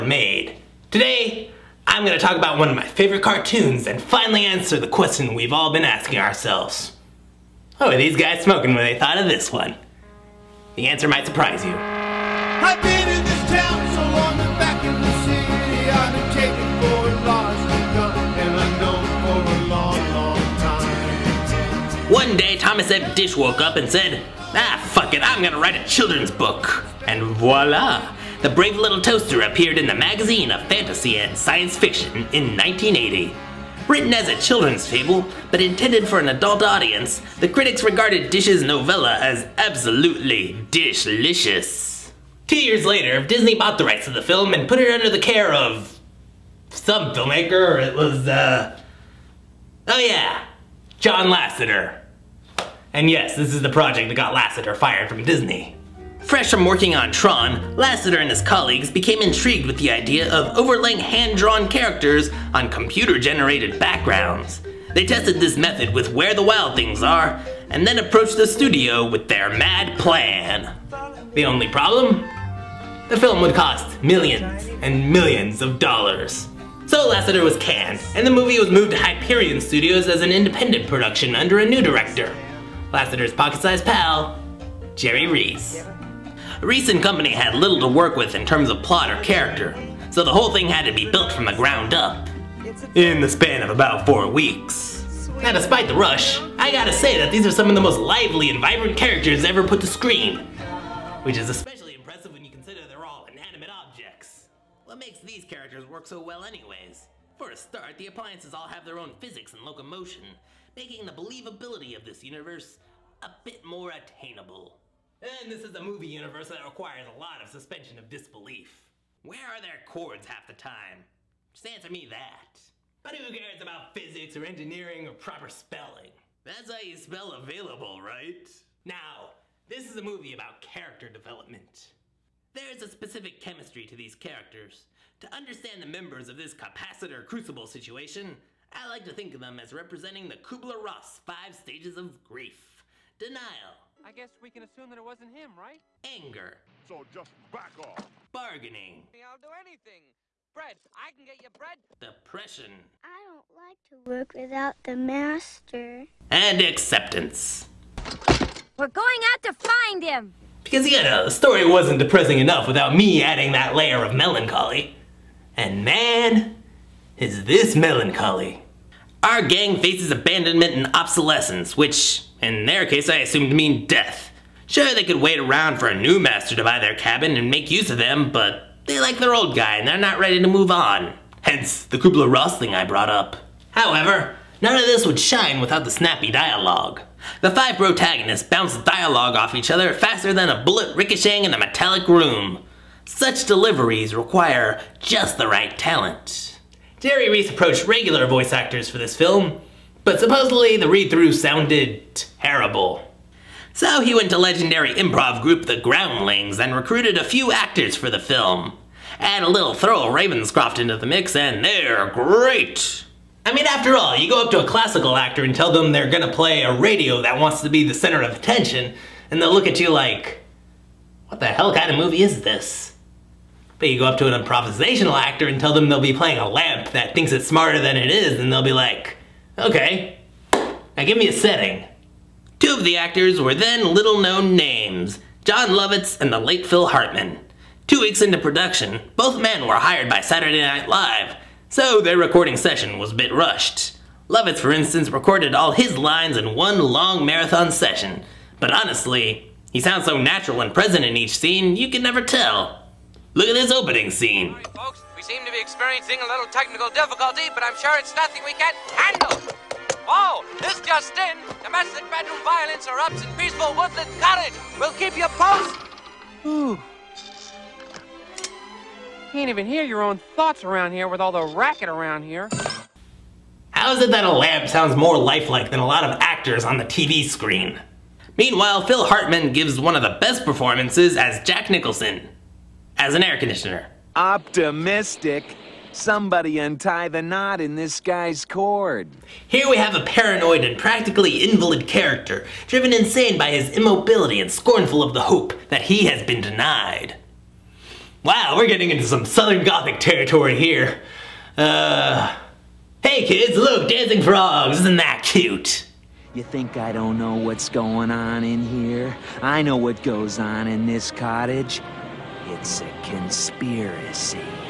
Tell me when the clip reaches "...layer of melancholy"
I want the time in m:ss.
2:43.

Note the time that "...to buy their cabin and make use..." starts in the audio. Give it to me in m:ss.
2:56.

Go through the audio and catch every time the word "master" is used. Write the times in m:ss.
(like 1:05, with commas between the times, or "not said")
2:34, 2:56.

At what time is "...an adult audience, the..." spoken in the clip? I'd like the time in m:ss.
0:36.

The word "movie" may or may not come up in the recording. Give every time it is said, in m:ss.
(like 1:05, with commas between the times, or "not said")
1:18, 1:55, 2:10, 3:41.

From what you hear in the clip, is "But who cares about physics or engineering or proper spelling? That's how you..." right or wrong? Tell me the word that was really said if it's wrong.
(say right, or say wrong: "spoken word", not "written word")
right.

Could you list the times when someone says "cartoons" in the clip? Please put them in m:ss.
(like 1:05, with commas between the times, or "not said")
0:03.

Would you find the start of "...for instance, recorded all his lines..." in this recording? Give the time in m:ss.
4:04.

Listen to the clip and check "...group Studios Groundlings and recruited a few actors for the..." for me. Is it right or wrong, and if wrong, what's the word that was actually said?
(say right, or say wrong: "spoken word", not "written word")
wrong: "The", not "Studios".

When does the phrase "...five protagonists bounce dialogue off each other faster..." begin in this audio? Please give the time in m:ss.
3:07.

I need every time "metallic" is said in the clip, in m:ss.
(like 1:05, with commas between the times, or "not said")
3:11.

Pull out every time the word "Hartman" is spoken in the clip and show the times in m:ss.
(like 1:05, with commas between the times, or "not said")
3:56, 4:39.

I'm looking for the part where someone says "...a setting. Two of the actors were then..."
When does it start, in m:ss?
3:51.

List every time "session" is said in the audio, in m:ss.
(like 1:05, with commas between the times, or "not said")
4:02, 4:07.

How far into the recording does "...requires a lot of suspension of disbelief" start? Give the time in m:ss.
1:56.